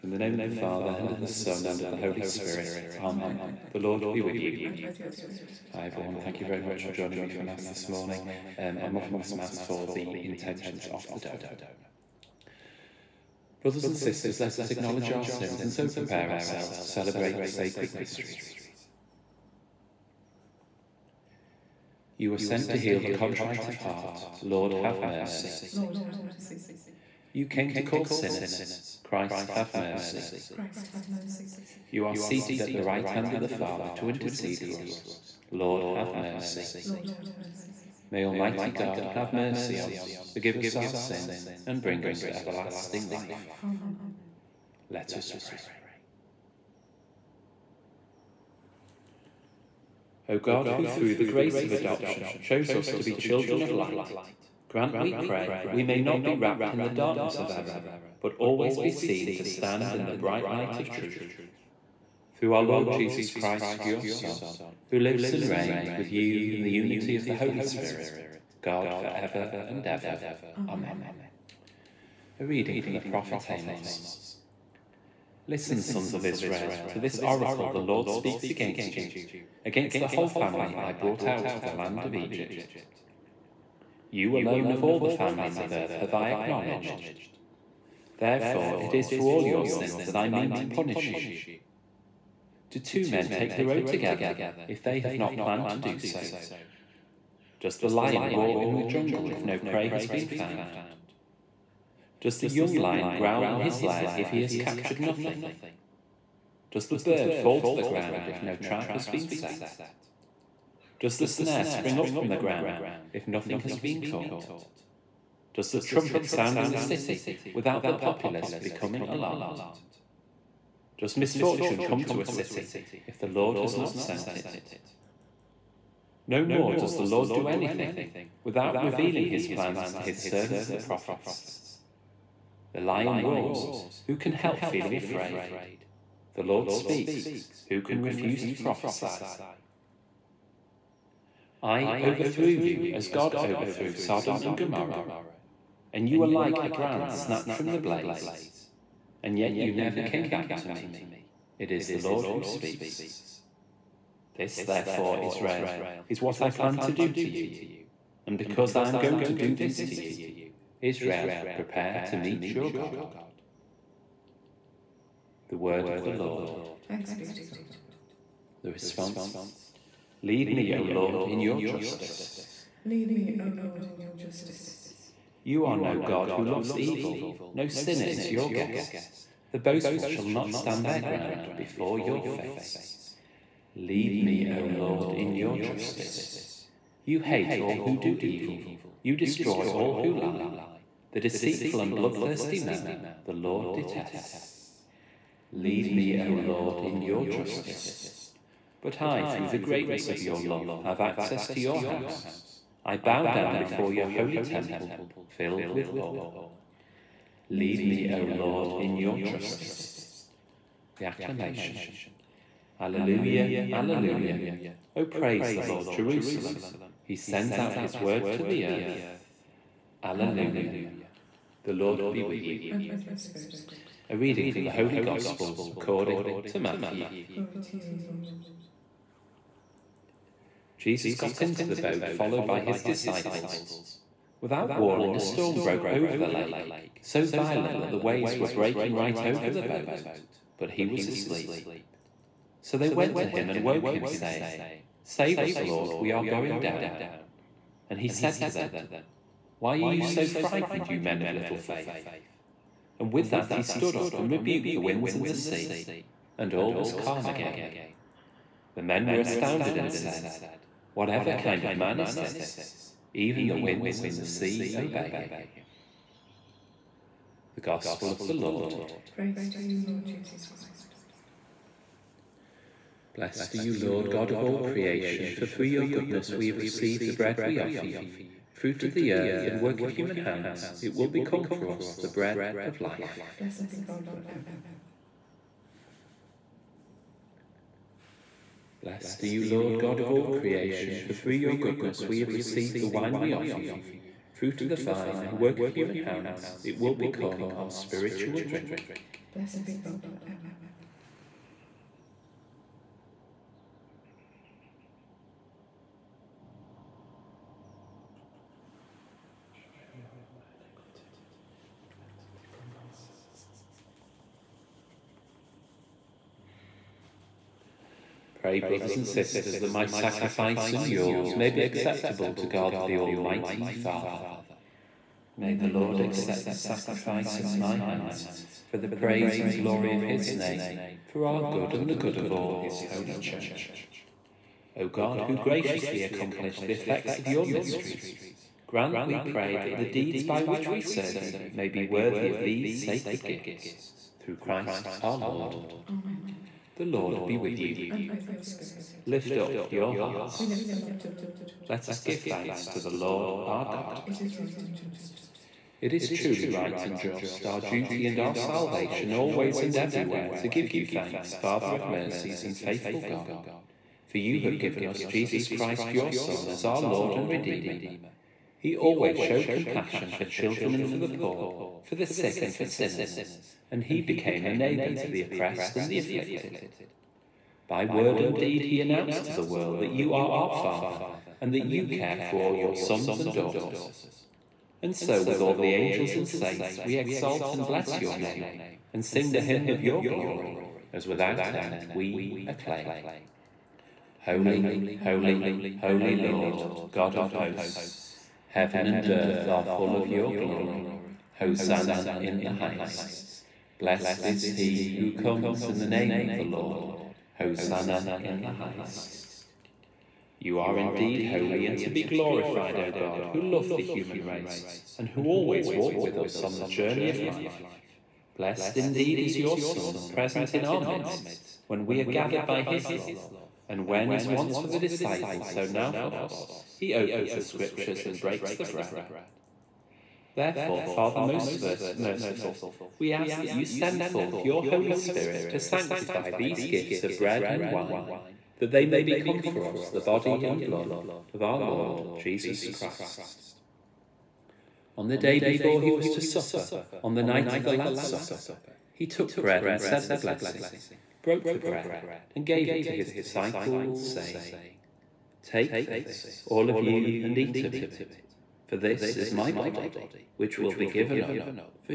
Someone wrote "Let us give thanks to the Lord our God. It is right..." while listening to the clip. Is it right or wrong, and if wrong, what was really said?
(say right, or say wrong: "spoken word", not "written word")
right.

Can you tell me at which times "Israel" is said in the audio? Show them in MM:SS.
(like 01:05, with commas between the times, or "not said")
01:16, 02:35, 02:40.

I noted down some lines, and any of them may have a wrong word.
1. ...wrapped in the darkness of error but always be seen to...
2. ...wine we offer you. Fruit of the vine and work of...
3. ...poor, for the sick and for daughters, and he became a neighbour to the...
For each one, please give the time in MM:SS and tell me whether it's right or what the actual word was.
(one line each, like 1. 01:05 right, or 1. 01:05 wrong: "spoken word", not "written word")
1. 00:56 right
2. 04:52 right
3. 06:11 wrong: "sinners", not "daughters".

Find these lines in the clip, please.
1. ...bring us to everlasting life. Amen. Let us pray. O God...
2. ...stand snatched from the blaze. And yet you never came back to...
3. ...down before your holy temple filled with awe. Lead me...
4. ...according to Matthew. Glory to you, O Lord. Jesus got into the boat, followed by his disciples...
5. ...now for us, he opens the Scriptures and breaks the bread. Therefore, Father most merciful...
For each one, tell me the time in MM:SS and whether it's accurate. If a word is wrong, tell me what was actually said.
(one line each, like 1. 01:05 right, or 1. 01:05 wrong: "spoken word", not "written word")
1. 00:41 right
2. 02:26 wrong: "brand", not "stand"
3. 03:23 right
4. 03:45 right
5. 07:05 right.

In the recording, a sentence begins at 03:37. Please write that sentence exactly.
He sends out his word to the earth.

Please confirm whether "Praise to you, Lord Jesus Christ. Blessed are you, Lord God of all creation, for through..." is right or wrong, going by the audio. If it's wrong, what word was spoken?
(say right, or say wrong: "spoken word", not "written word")
right.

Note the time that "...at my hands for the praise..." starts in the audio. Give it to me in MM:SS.
05:27.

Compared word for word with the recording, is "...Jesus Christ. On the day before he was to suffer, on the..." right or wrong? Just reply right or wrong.
right.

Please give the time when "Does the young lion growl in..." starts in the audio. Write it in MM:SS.
01:42.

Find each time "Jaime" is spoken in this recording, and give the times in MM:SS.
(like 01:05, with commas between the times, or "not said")
not said.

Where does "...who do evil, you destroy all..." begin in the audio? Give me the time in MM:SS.
03:07.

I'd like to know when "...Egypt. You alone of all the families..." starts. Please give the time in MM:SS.
01:22.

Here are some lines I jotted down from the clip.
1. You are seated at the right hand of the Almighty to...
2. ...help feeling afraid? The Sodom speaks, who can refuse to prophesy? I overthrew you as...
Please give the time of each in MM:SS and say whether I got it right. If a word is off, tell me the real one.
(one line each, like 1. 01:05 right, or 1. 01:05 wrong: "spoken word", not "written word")
1. 00:31 wrong: "Father", not "Almighty"
2. 02:14 wrong: "Lord", not "Sodom".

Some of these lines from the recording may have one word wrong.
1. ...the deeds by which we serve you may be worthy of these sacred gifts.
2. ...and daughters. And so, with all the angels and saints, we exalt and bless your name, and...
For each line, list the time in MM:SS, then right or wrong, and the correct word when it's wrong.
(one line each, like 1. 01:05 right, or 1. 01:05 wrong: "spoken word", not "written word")
1. 05:39 right
2. 06:23 right.